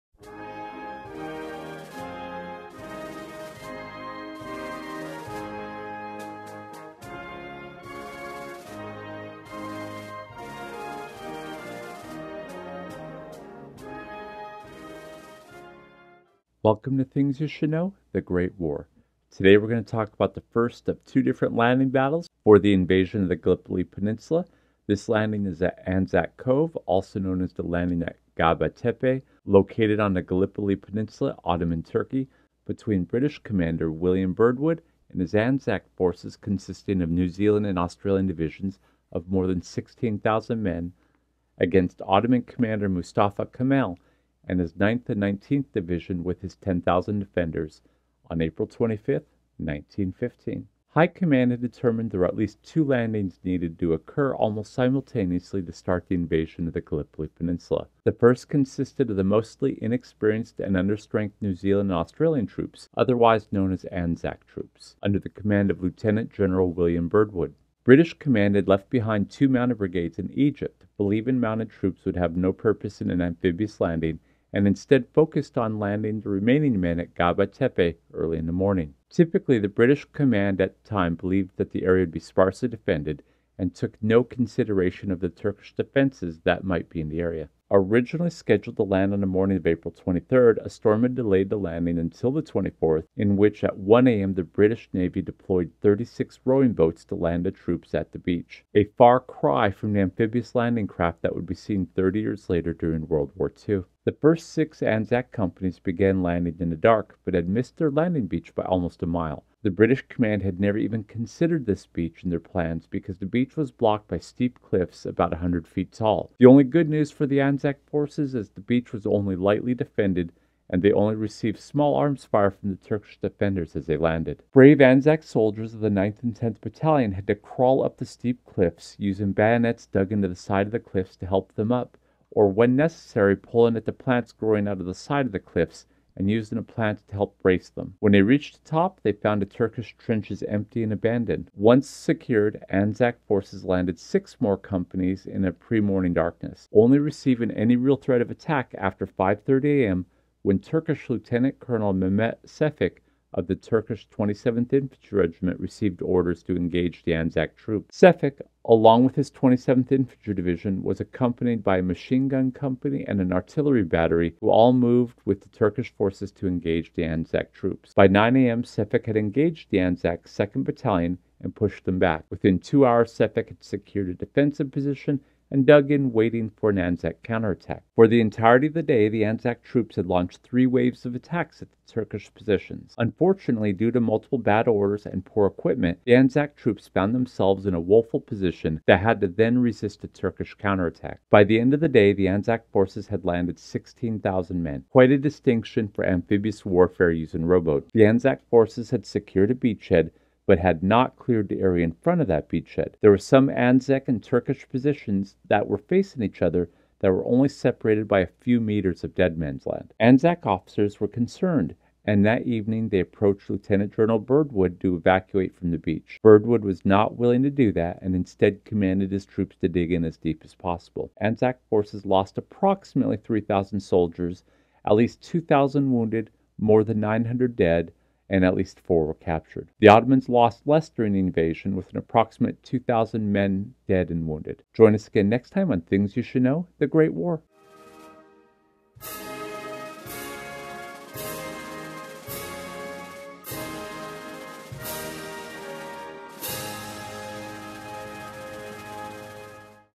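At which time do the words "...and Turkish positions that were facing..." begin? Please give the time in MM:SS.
03:24.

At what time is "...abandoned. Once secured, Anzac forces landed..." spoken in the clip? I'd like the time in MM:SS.
02:20.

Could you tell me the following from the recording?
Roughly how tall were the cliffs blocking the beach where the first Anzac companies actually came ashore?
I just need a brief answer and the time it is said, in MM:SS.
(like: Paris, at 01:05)
100 feet, at 01:55.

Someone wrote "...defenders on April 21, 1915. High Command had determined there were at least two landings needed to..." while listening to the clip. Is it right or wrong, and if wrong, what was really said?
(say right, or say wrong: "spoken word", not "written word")
wrong: "25", not "21".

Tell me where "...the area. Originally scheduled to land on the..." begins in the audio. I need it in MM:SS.
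01:27.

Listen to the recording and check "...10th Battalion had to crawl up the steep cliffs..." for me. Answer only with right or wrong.
right.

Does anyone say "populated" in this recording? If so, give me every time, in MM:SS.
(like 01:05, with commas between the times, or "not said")
not said.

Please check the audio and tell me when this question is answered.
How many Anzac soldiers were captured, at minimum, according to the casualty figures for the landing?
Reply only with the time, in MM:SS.
03:48.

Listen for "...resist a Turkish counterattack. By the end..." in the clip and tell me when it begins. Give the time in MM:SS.
03:09.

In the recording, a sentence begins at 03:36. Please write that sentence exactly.
Birdwood was not willing to do that and instead commanded his troops to dig in as deep as possible.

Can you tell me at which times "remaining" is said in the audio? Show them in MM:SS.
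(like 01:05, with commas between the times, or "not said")
01:16.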